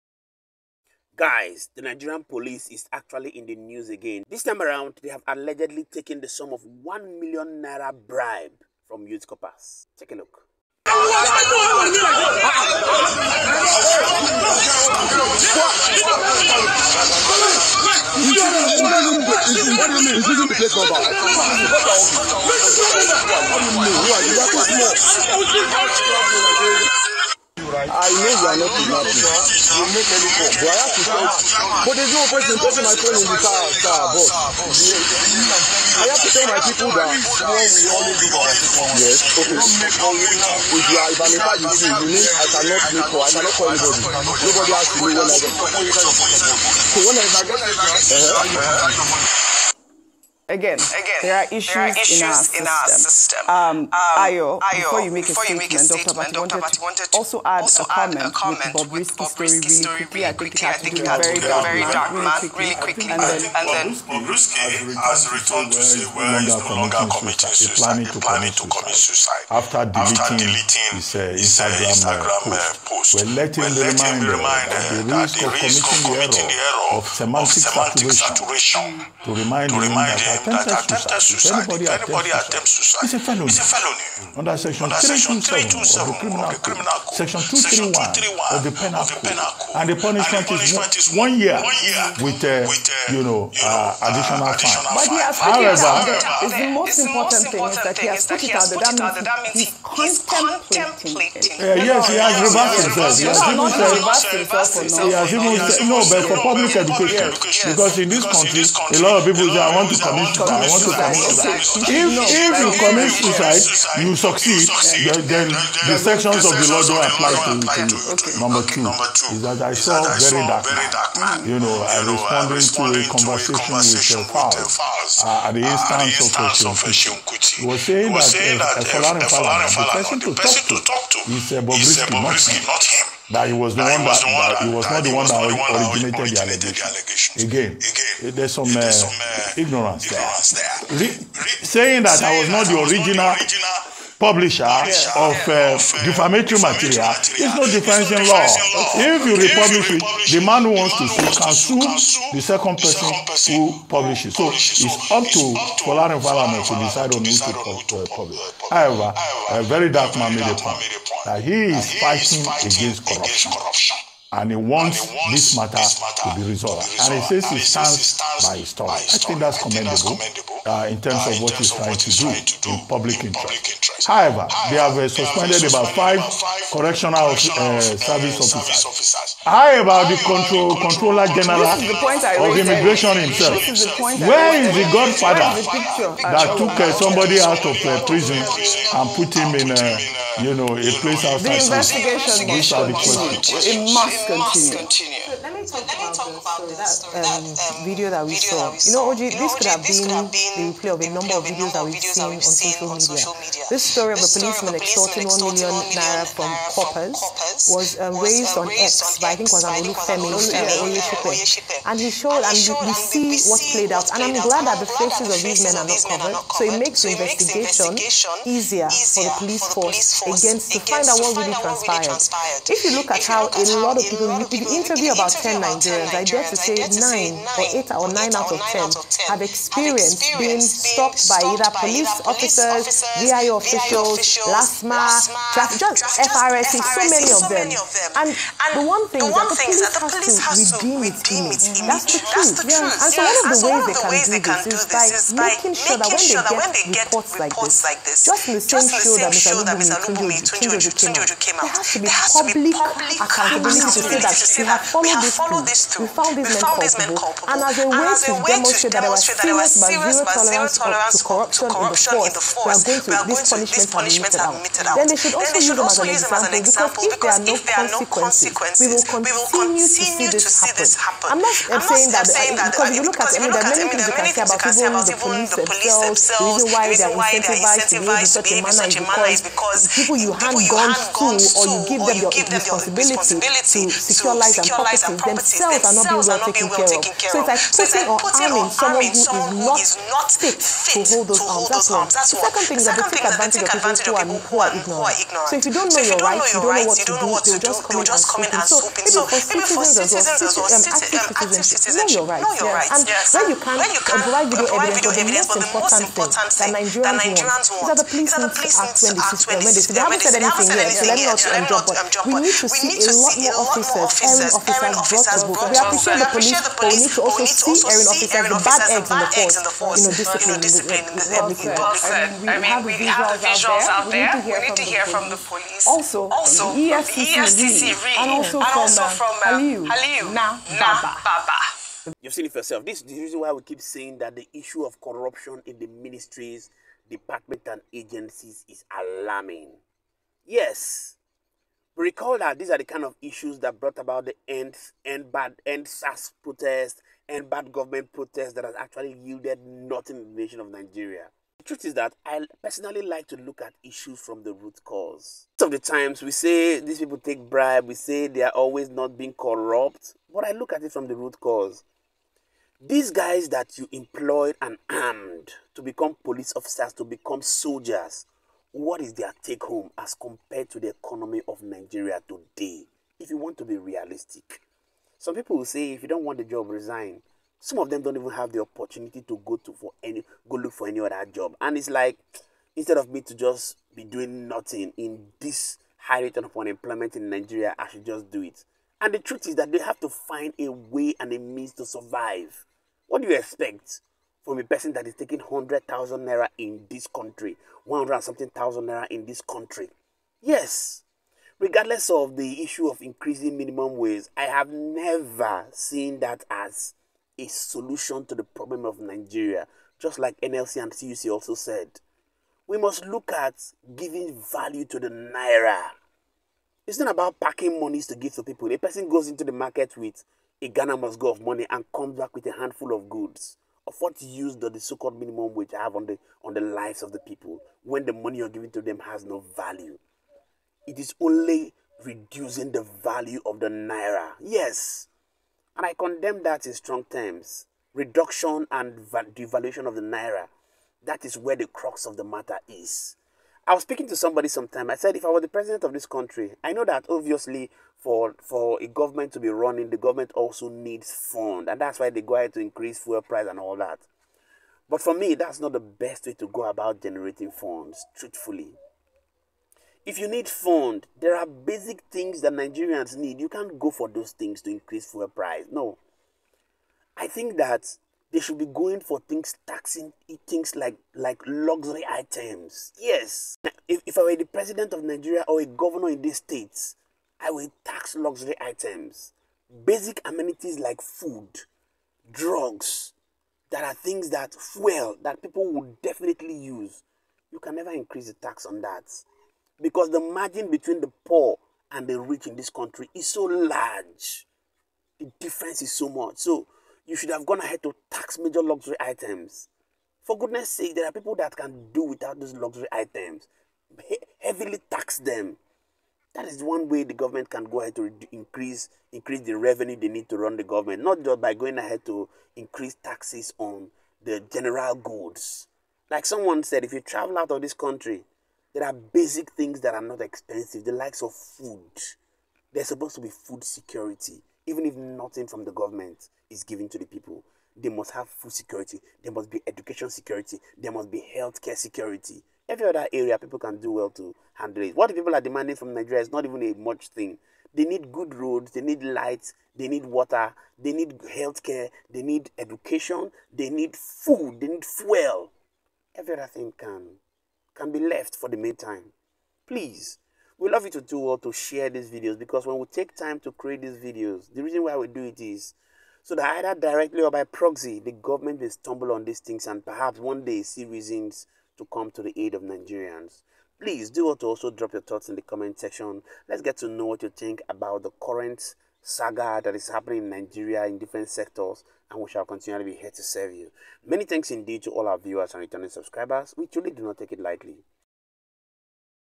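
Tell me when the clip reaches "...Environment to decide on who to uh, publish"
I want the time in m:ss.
2:36.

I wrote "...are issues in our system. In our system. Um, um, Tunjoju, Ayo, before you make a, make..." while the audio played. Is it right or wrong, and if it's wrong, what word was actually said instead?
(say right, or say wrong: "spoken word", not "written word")
wrong: "Ayo", not "Tunjoju".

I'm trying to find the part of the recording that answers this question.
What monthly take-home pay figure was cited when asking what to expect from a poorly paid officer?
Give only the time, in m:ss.
6:35.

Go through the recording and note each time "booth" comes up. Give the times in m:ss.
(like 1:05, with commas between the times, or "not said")
not said.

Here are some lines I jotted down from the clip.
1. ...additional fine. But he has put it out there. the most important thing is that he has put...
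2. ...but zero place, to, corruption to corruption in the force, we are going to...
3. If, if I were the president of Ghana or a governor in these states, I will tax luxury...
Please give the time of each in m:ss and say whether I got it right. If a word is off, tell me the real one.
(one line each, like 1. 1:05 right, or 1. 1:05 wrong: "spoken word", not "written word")
1. 1:34 right
2. 4:20 wrong: "tolerance", not "place"
3. 7:53 wrong: "Nigeria", not "Ghana".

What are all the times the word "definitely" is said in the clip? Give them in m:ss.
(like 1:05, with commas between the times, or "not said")
8:06.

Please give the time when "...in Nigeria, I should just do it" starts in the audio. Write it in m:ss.
6:27.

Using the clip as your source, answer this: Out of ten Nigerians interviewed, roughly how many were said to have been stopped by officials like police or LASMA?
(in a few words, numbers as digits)
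8 or 9.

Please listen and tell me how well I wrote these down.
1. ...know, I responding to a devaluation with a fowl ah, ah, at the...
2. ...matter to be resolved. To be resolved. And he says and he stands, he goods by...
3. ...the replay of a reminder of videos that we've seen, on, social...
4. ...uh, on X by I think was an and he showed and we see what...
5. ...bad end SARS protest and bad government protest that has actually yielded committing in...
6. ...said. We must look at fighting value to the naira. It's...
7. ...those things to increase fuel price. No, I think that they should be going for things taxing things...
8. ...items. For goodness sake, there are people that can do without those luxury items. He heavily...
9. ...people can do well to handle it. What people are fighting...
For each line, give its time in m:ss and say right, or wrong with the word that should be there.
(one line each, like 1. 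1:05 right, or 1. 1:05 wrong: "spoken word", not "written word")
1. 2:01 wrong: "conversation", not "devaluation"
2. 2:45 wrong: "stands", not "goods"
3. 3:20 wrong: "number", not "reminder"
4. 3:28 right
5. 5:45 wrong: "nothing", not "committing"
6. 6:51 wrong: "giving", not "fighting"
7. 7:44 right
8. 8:19 right
9. 8:53 wrong: "demanding", not "fighting".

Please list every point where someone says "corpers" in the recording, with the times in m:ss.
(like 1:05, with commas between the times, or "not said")
0:09, 3:26.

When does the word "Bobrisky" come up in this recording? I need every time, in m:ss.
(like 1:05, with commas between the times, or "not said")
0:59, 1:04.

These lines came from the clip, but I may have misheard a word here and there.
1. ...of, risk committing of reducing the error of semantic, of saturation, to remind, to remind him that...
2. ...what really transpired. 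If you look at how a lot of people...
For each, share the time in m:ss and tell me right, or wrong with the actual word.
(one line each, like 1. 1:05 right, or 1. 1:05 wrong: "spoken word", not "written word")
1. 1:15 wrong: "committing", not "reducing"
2. 3:41 right.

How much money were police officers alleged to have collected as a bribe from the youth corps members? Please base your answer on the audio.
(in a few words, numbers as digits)
1 million naira.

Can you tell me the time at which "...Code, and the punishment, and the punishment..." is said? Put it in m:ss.
1:29.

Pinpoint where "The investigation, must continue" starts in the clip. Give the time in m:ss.
3:11.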